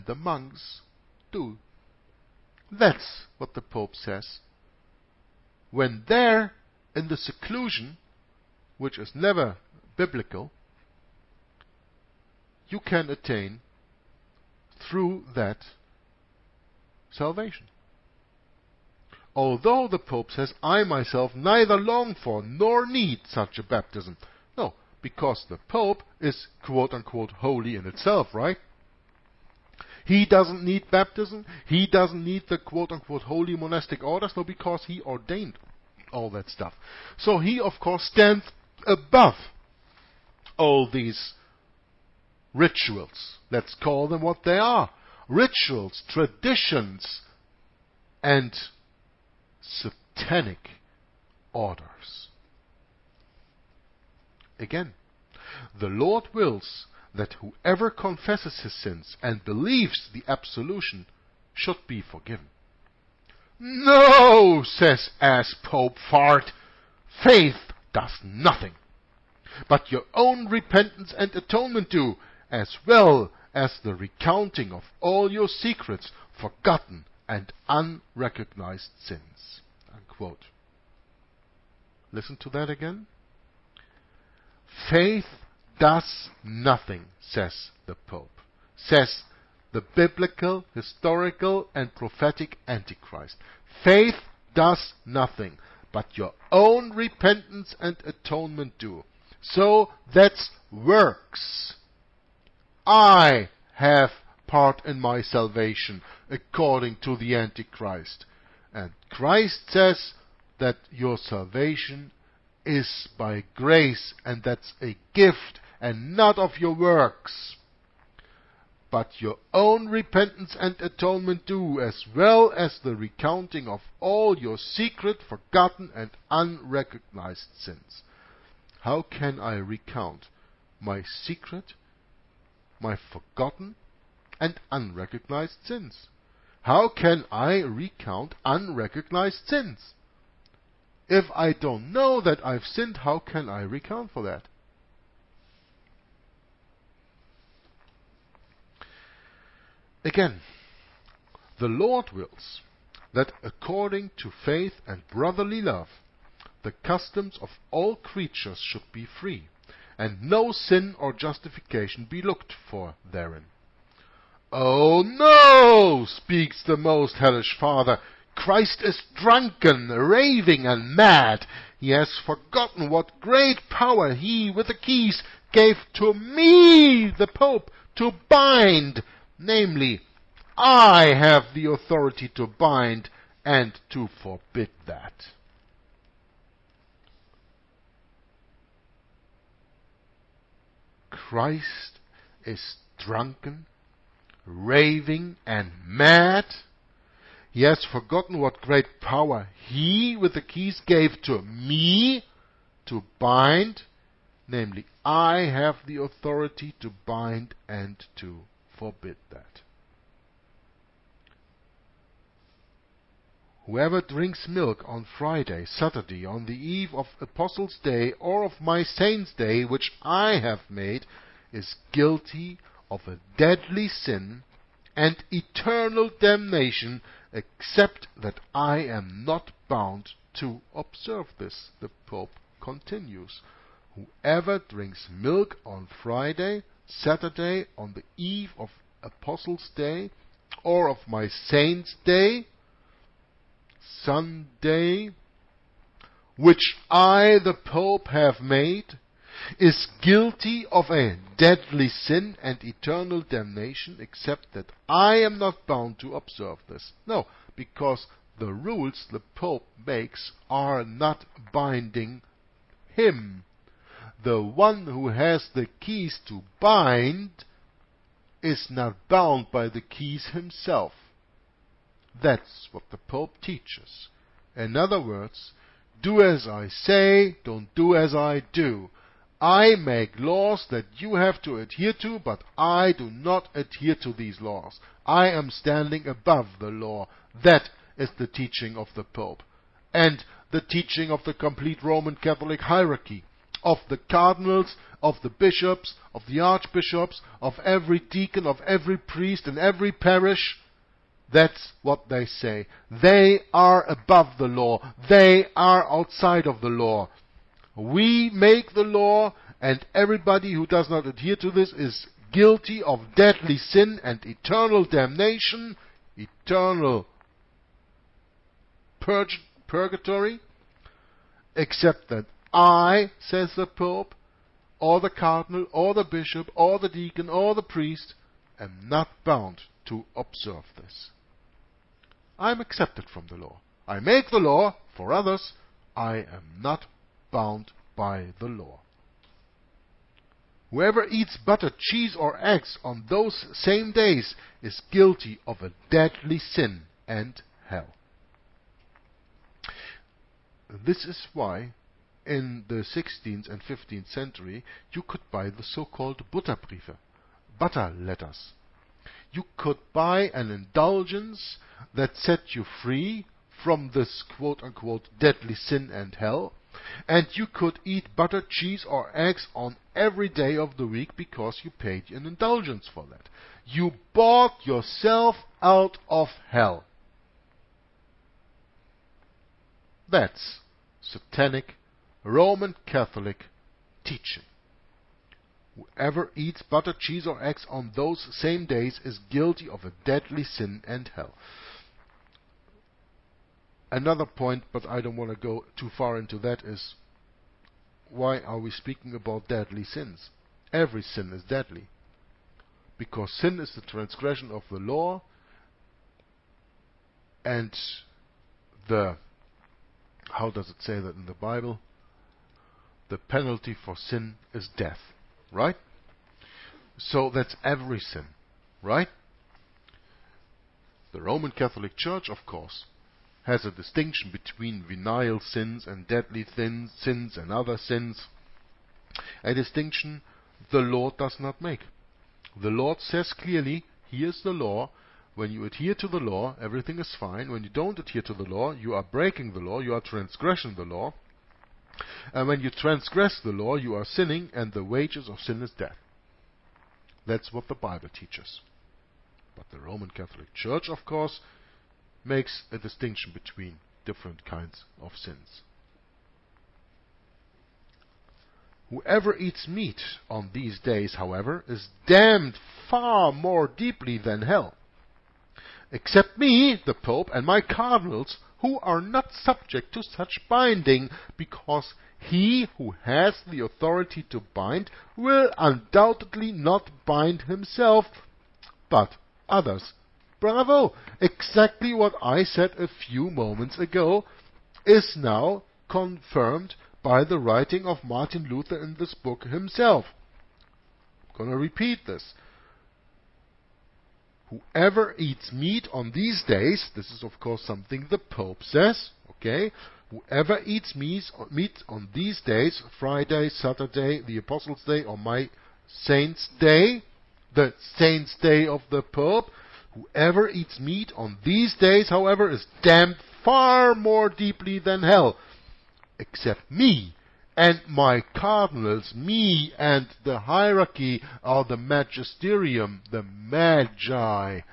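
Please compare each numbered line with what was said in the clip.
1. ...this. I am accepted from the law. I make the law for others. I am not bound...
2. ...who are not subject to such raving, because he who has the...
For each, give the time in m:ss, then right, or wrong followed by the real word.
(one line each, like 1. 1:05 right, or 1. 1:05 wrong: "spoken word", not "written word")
1. 5:30 right
2. 7:48 wrong: "binding", not "raving".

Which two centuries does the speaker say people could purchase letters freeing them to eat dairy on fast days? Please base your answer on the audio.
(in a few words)
16th and 15th.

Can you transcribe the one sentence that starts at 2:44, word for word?
Oh no, speaks the most hellish father, Christ is drunken, raving, and mad.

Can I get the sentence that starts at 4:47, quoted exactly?
That is the teaching of the Pope.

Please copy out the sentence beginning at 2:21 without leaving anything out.
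If I don't know that I've sinned, how can I recount for that?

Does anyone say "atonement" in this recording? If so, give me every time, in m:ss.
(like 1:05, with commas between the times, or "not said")
1:11, 1:38, 2:00.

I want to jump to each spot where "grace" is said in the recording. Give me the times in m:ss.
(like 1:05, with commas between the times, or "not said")
1:53.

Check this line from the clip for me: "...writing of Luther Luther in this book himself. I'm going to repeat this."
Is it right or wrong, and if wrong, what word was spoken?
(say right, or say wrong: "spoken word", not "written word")
wrong: "Martin", not "Luther".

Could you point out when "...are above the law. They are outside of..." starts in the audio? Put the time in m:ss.
5:03.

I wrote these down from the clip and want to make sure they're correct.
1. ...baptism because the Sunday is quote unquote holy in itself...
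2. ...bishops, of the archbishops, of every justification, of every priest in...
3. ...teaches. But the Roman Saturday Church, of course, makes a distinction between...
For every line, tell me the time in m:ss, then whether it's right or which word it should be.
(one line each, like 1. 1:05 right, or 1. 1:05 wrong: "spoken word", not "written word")
1. 0:23 wrong: "Pope", not "Sunday"
2. 4:55 wrong: "deacon", not "justification"
3. 7:28 wrong: "Catholic", not "Saturday".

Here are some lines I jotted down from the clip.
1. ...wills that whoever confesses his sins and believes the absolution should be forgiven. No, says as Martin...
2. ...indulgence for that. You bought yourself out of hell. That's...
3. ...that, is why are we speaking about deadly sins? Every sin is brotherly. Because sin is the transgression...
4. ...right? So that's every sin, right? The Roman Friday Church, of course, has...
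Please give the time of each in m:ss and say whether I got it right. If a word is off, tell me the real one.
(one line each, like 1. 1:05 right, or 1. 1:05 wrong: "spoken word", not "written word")
1. 0:56 wrong: "Pope", not "Martin"
2. 6:12 right
3. 6:36 wrong: "deadly", not "brotherly"
4. 6:55 wrong: "Catholic", not "Friday".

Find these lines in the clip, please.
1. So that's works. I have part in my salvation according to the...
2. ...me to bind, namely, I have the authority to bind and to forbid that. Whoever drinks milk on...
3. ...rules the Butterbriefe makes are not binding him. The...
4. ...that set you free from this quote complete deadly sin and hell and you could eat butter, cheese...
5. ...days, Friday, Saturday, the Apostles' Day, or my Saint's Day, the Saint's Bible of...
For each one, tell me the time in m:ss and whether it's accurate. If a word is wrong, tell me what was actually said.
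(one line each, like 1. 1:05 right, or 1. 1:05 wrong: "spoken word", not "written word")
1. 1:39 right
2. 3:21 right
3. 4:18 wrong: "Pope", not "Butterbriefe"
4. 6:01 wrong: "unquote", not "complete"
5. 8:22 wrong: "Day", not "Bible".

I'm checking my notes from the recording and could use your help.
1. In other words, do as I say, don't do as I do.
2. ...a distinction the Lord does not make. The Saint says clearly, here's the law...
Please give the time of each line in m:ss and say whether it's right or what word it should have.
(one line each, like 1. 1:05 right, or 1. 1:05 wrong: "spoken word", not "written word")
1. 4:34 right
2. 7:09 wrong: "Lord", not "Saint".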